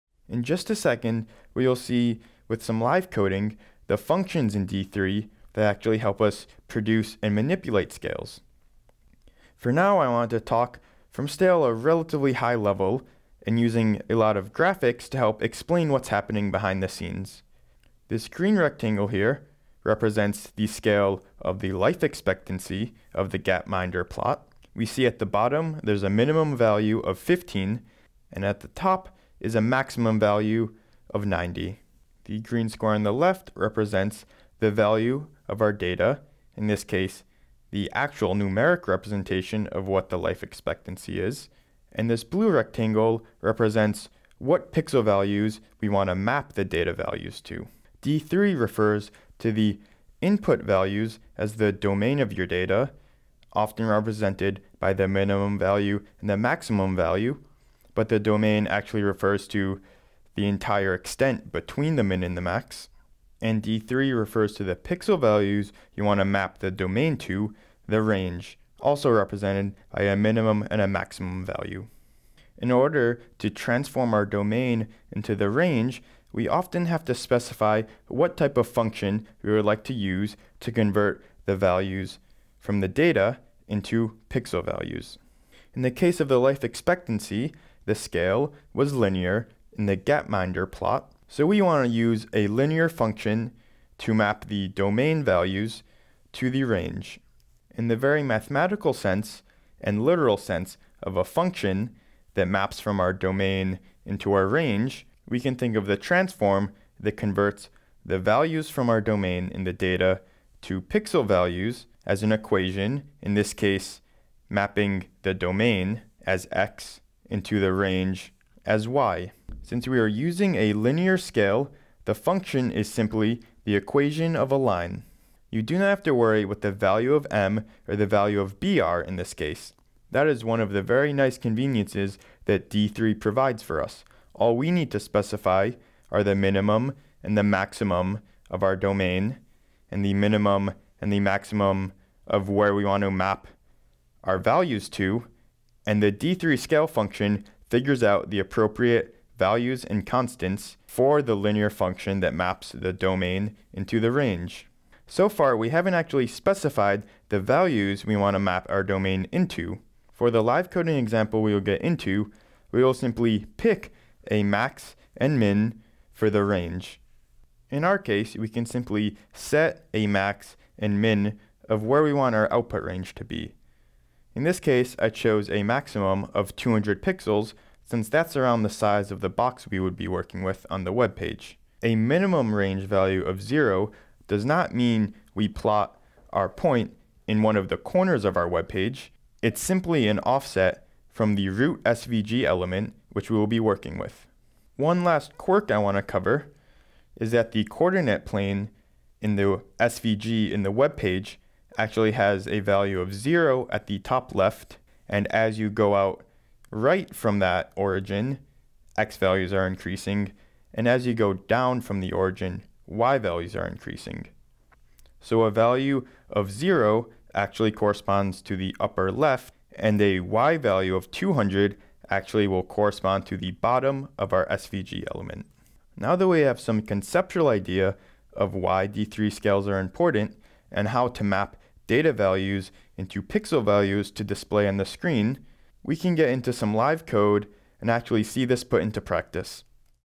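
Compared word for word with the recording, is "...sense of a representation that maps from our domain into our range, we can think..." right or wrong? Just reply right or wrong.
wrong.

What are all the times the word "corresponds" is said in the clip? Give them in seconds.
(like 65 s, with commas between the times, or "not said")
217 s, 222 s.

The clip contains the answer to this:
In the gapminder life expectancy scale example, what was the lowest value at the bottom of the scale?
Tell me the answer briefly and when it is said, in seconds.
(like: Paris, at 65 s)
15, at 27 s.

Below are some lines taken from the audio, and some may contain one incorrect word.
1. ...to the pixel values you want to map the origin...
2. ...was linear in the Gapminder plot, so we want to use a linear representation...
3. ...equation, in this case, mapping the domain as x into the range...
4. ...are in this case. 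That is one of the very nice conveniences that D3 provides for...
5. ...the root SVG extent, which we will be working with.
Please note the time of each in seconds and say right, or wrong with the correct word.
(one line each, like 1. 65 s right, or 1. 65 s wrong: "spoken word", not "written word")
1. 64 s wrong: "domain", not "origin"
2. 88 s wrong: "function", not "representation"
3. 112 s right
4. 128 s right
5. 191 s wrong: "element", not "extent".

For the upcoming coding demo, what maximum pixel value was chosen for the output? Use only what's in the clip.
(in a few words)
200 pixels.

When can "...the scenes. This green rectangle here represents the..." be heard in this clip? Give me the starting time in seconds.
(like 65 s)
16 s.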